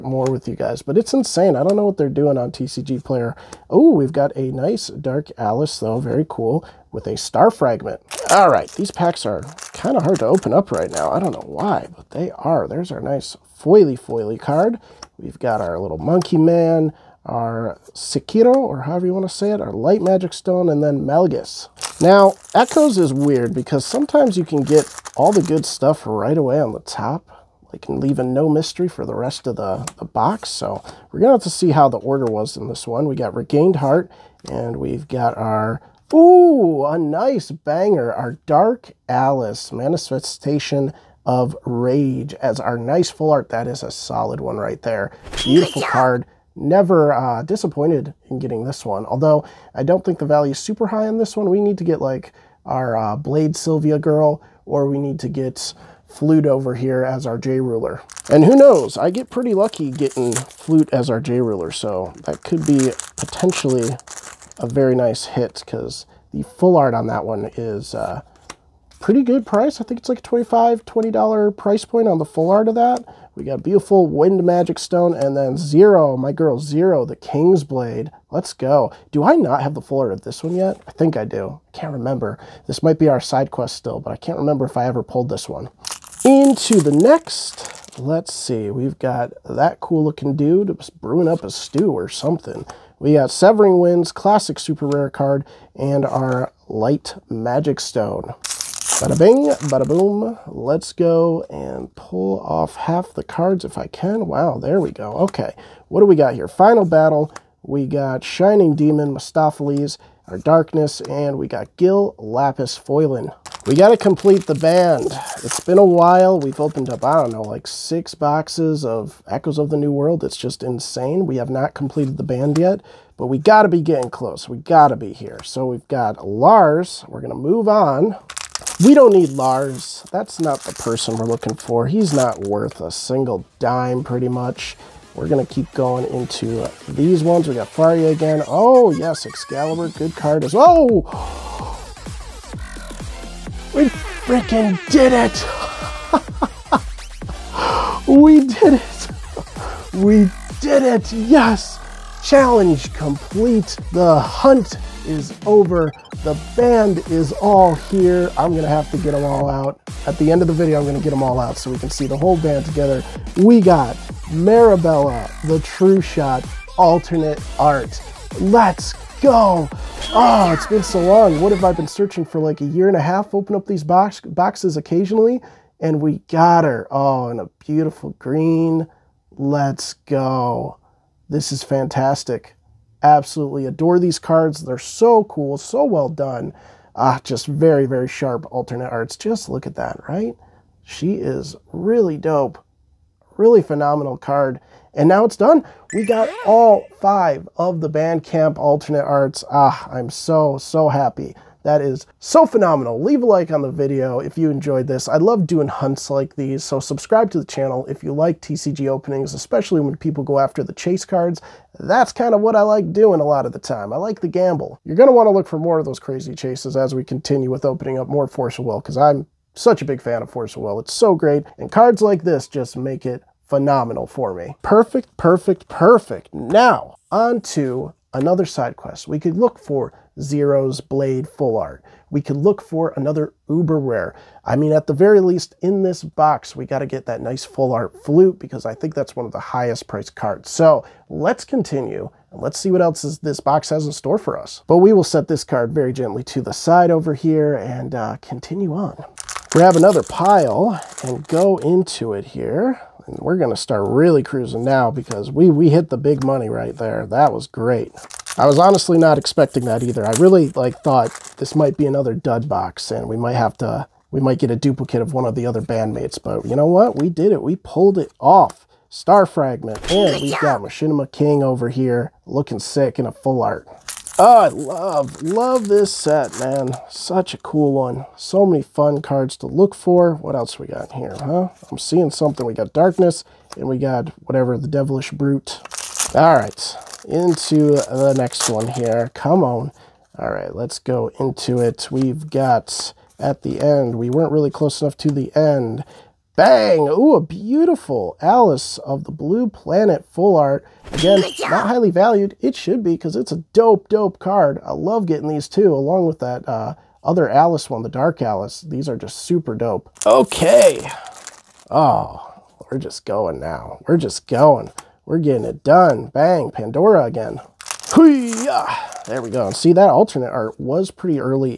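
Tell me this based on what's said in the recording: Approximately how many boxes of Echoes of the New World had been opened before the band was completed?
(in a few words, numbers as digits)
6.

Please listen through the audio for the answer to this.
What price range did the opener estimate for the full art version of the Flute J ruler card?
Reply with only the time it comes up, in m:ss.
1:10.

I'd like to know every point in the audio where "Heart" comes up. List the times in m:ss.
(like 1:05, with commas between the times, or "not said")
0:33.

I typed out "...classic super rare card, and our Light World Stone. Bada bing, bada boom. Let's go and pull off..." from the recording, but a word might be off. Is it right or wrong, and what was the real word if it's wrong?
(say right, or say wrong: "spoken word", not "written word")
wrong: "Magic", not "World".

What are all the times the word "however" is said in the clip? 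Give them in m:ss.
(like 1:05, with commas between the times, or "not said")
0:18.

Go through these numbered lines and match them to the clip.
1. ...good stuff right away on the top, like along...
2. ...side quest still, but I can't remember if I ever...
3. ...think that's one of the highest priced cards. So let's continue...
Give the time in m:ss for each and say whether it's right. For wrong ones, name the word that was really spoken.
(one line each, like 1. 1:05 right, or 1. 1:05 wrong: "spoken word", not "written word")
1. 0:25 wrong: "leaving", not "along"
2. 1:23 right
3. 3:58 right.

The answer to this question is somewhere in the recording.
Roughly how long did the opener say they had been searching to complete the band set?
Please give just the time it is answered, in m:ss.
2:52.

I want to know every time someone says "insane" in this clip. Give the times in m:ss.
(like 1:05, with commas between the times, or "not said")
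0:01, 2:00.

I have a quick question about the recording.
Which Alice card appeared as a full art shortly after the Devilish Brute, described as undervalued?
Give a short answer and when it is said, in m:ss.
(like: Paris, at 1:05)
Alice of the Blue Planet, at 4:58.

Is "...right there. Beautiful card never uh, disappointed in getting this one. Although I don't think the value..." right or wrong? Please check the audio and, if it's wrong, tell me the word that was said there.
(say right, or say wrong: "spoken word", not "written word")
right.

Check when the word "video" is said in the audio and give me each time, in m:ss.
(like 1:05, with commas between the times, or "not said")
2:40, 3:23.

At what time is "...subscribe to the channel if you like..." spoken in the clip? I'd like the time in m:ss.
3:26.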